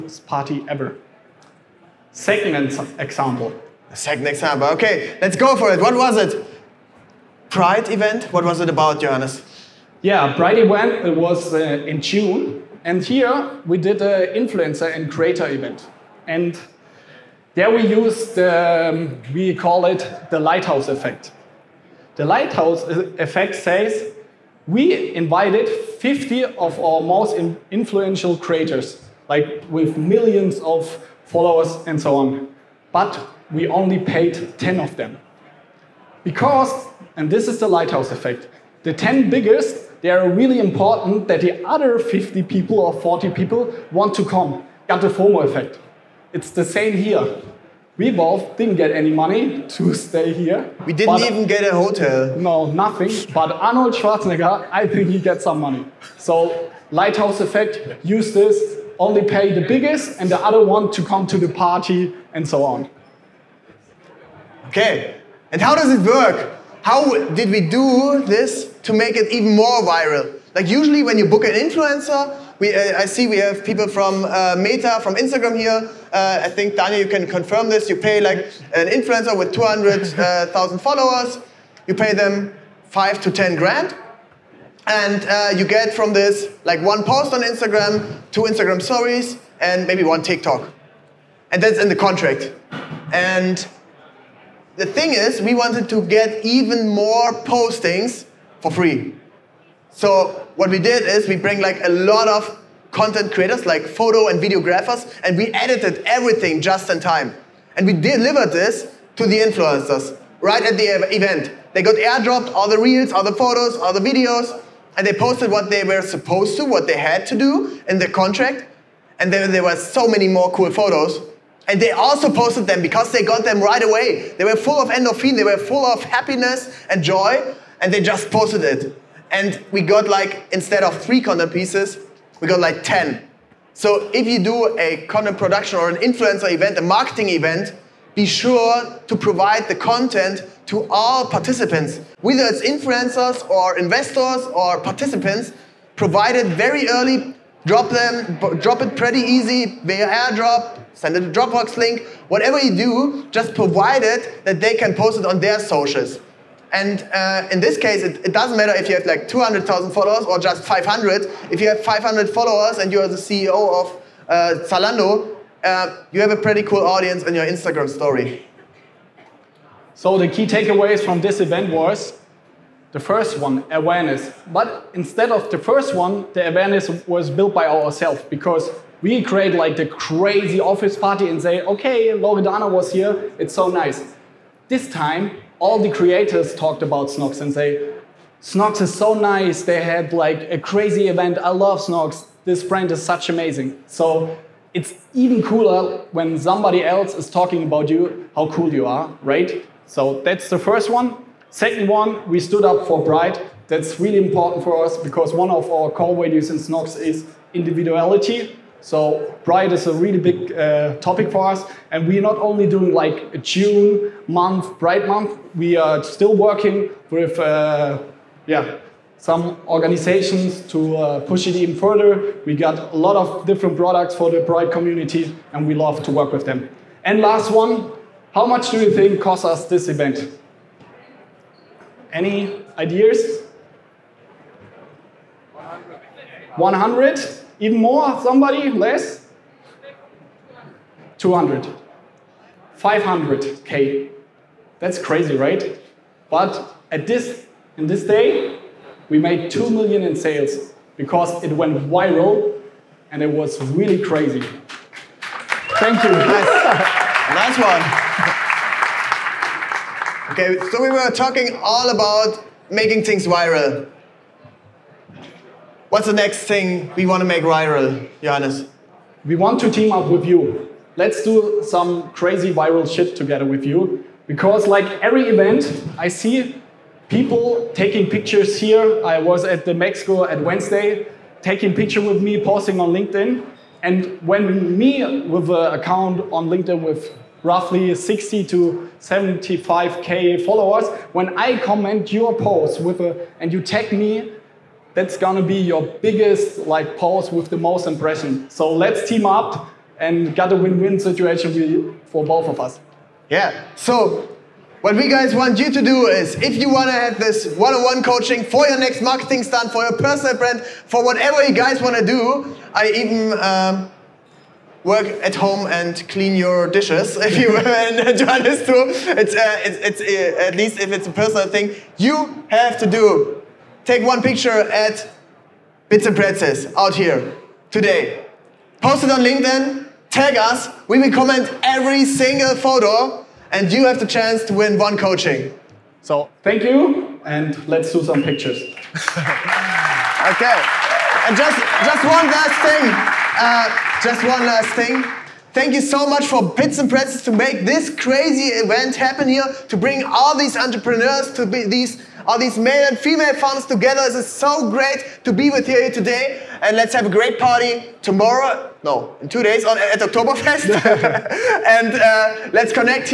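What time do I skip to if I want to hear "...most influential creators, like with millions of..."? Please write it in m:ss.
0:27.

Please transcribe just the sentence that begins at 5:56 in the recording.
And let's have a great party tomorrow, no, in two days on, at Oktoberfest.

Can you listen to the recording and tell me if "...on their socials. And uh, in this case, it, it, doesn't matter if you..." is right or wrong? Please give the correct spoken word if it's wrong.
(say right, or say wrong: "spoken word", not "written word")
right.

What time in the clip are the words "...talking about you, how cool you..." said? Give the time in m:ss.
3:17.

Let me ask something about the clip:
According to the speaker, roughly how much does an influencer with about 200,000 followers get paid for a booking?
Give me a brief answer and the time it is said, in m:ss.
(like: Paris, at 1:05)
5 to 10 grand, at 1:22.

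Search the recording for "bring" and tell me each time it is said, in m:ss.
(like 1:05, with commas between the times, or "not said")
1:41, 5:49.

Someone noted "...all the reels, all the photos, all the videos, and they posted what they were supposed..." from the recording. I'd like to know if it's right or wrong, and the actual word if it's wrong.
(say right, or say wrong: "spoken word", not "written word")
right.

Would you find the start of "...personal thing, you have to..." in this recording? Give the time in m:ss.
5:21.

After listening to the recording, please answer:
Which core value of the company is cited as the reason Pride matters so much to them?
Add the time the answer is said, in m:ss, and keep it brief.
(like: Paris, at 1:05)
individuality, at 3:27.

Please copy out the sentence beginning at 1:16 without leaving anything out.
Uh, I think, Daniel, you can confirm this.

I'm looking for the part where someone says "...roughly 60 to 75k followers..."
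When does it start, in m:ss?
4:47.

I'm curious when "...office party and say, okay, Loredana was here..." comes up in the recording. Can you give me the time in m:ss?
3:00.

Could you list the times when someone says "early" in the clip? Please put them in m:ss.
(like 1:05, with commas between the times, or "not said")
2:26.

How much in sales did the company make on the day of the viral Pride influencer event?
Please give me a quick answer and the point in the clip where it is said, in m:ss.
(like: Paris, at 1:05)
2 million, at 4:09.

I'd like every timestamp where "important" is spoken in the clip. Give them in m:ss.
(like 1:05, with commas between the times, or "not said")
0:40, 3:24.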